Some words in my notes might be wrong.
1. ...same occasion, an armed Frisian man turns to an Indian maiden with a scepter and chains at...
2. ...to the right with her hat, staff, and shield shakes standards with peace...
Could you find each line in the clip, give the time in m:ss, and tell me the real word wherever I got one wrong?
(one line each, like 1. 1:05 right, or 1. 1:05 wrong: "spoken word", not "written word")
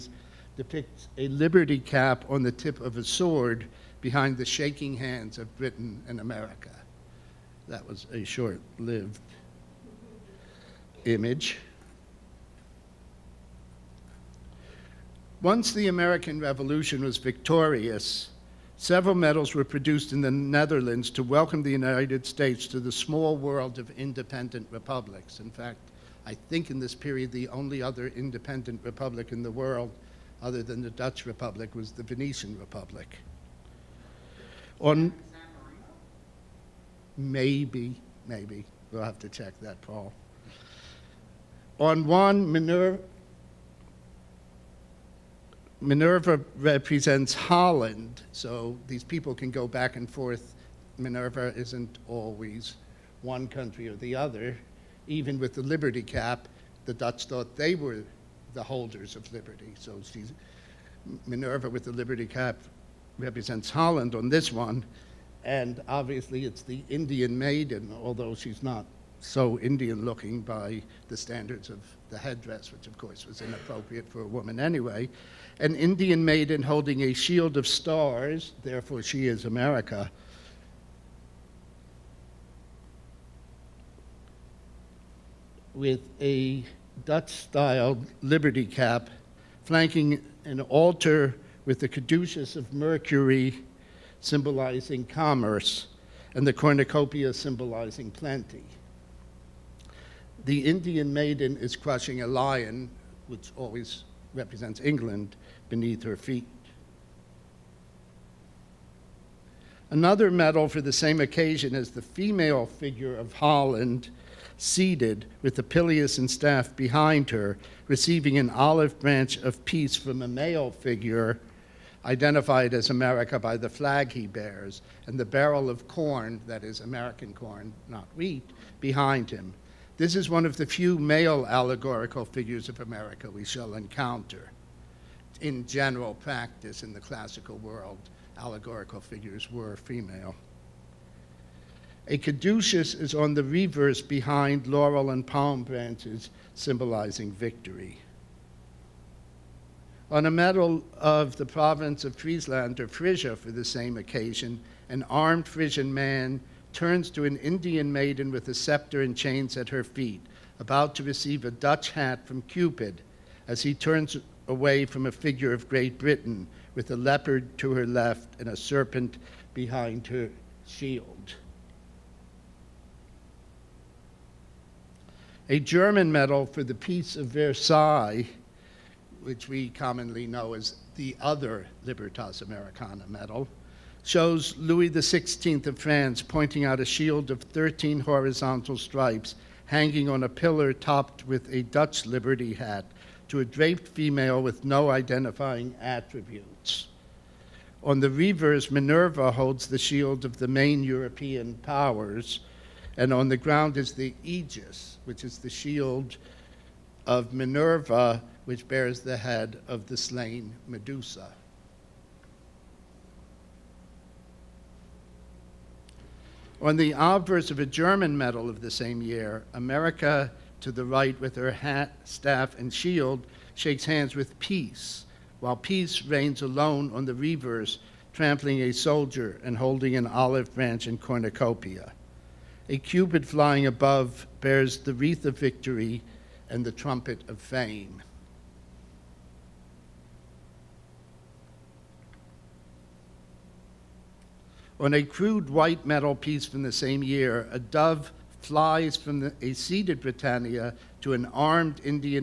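1. 2:33 right
2. 3:40 wrong: "hands", not "standards".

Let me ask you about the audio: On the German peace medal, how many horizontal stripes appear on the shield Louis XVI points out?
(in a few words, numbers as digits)
13.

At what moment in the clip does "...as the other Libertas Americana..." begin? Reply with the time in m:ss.
3:00.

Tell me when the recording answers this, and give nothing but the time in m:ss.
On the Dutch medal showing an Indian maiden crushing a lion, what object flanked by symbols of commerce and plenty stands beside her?
1:30.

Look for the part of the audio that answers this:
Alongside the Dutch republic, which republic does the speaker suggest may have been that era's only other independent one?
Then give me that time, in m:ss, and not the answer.
0:32.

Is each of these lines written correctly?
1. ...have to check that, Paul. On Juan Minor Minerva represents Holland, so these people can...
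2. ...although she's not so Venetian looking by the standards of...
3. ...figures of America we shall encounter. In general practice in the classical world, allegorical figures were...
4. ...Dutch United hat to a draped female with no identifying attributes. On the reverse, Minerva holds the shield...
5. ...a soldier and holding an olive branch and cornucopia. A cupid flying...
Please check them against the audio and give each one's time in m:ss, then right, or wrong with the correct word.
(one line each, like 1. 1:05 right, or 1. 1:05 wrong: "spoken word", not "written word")
1. 0:39 right
2. 1:08 wrong: "Indian", not "Venetian"
3. 2:12 right
4. 3:11 wrong: "Liberty", not "United"
5. 3:48 right.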